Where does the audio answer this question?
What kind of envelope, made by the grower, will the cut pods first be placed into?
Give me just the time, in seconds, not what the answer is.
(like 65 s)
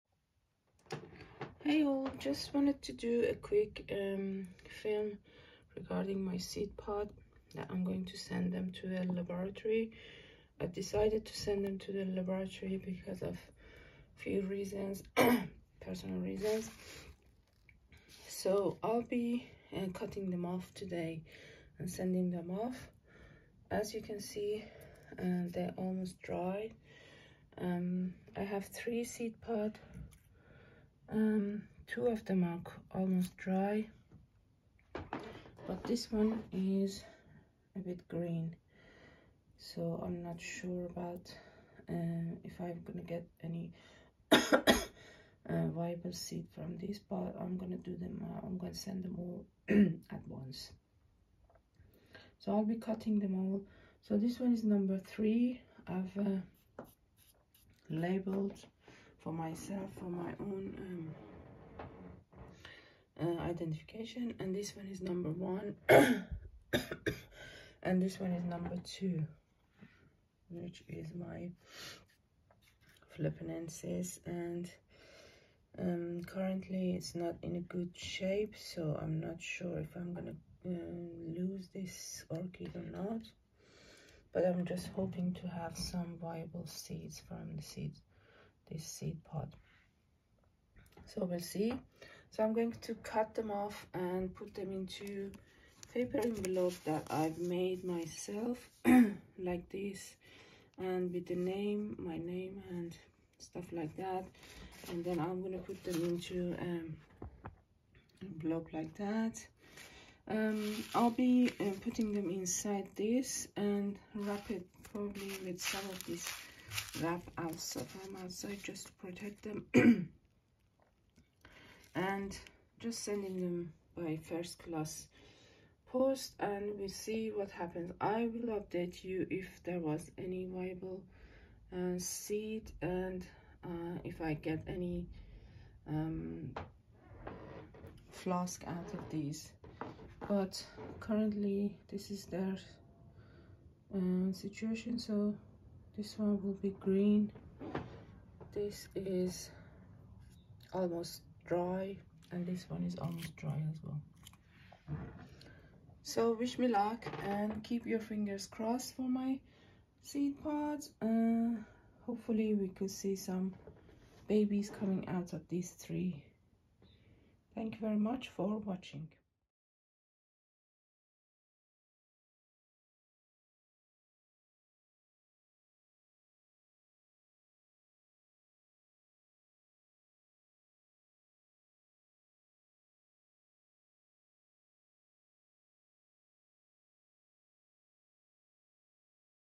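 95 s.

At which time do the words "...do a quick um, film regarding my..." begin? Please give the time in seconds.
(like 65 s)
2 s.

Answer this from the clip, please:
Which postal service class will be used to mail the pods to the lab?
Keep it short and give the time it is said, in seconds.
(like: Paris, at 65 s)
First class, at 124 s.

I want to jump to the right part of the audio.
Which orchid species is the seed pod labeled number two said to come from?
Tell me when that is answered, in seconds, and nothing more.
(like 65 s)
73 s.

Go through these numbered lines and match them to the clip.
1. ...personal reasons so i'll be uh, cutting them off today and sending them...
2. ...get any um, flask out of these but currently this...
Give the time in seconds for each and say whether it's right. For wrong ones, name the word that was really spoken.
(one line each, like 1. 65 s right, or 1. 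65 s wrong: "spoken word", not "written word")
1. 15 s right
2. 134 s right.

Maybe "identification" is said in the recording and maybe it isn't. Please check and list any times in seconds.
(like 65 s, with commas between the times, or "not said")
63 s.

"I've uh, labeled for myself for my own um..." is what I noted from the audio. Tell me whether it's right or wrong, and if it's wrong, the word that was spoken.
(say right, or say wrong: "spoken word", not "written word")
right.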